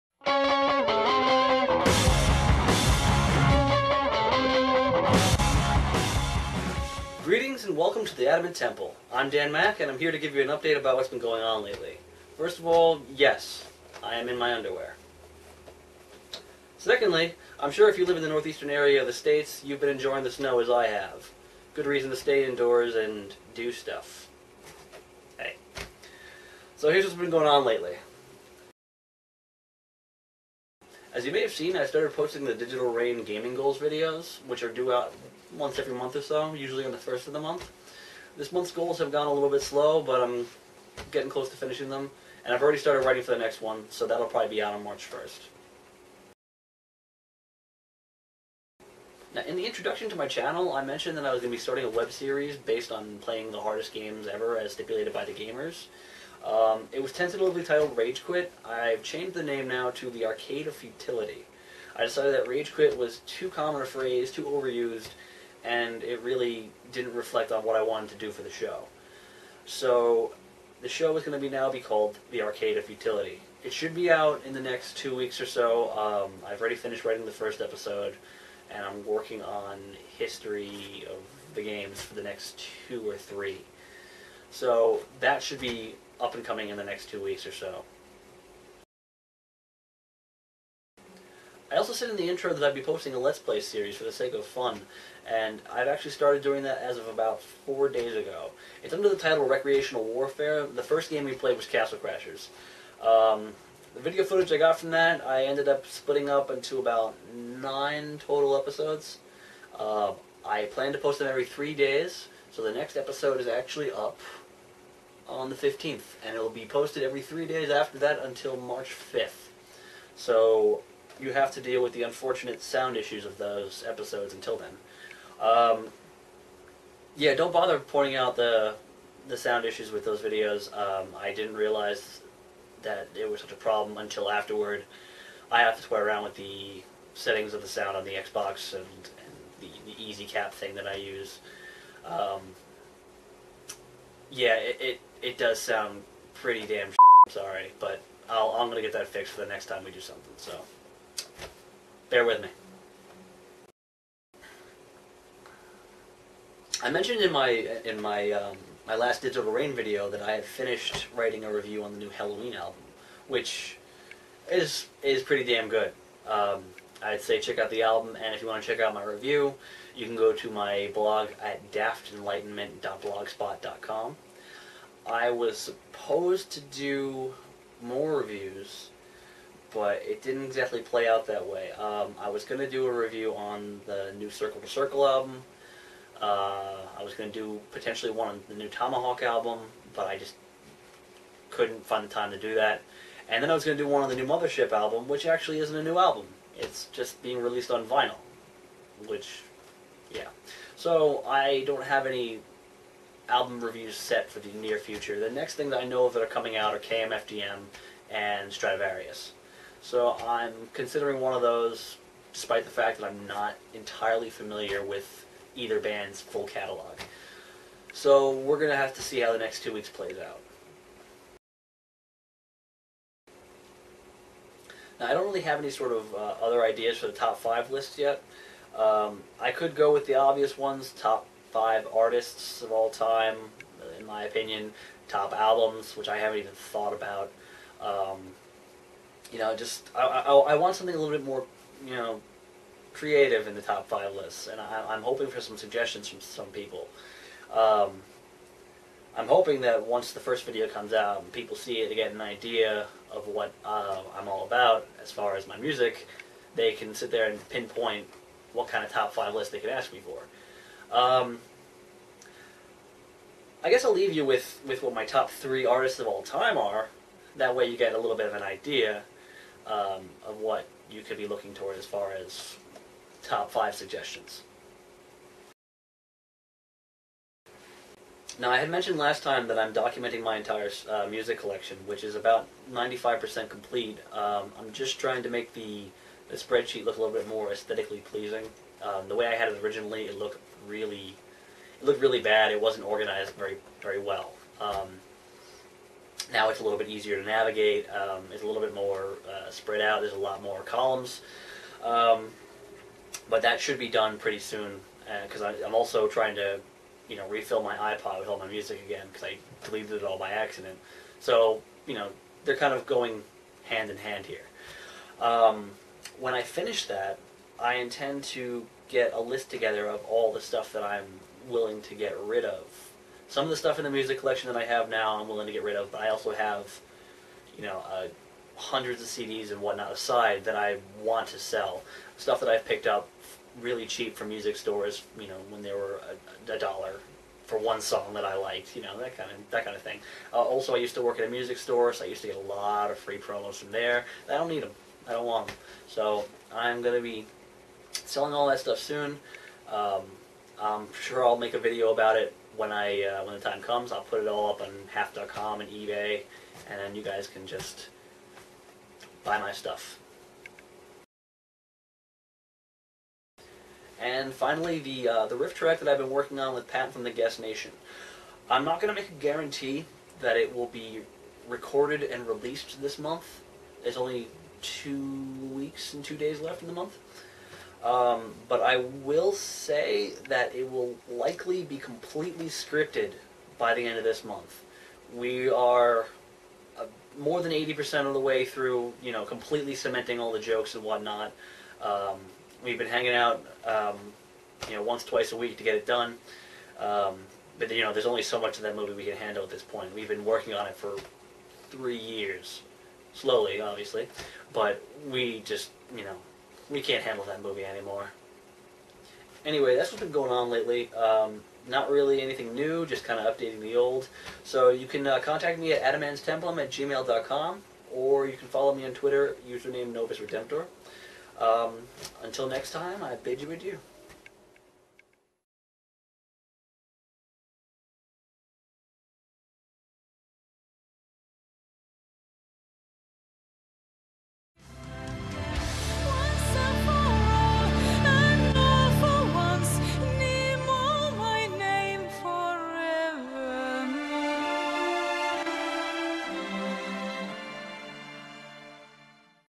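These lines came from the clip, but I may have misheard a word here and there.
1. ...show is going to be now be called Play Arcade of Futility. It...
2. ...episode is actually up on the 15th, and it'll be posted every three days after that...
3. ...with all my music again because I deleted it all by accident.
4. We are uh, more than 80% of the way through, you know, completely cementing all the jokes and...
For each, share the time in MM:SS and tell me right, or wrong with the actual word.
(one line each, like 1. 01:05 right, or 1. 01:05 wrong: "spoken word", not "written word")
1. 01:10 wrong: "The", not "Play"
2. 01:52 right
3. 05:08 right
4. 06:25 right.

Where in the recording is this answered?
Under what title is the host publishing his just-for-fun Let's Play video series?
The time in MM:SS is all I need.
01:39.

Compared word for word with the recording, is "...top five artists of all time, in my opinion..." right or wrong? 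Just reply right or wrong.
right.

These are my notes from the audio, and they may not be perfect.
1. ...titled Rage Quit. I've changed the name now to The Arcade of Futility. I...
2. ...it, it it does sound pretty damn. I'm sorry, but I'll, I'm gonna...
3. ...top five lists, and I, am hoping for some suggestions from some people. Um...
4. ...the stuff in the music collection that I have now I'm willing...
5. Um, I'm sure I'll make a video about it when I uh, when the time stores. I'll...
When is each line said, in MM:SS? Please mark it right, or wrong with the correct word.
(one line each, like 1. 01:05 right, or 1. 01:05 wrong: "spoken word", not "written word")
1. 00:57 right
2. 02:24 right
3. 04:03 right
4. 05:23 right
5. 05:49 wrong: "comes", not "stores".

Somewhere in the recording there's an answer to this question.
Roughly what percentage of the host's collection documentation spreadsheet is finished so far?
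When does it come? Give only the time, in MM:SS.
04:42.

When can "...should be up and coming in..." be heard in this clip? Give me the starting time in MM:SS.
01:25.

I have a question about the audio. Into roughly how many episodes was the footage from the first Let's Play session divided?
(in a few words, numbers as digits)
9.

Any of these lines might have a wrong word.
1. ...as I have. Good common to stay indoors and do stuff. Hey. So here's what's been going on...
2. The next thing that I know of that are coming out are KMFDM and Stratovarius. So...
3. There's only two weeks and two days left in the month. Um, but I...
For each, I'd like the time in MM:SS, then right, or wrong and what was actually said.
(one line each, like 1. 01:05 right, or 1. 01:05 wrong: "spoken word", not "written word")
1. 00:20 wrong: "reason", not "common"
2. 03:25 right
3. 06:13 right.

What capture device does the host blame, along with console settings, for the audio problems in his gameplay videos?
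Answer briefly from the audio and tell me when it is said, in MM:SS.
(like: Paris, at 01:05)
Easy Cap, at 02:20.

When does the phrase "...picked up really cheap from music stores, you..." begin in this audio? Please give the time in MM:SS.
05:32.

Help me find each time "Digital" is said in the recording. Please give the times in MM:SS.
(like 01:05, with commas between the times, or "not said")
00:32, 02:39.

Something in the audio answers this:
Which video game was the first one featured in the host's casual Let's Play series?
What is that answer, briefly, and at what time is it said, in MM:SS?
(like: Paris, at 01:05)
Castle Crashers, at 01:41.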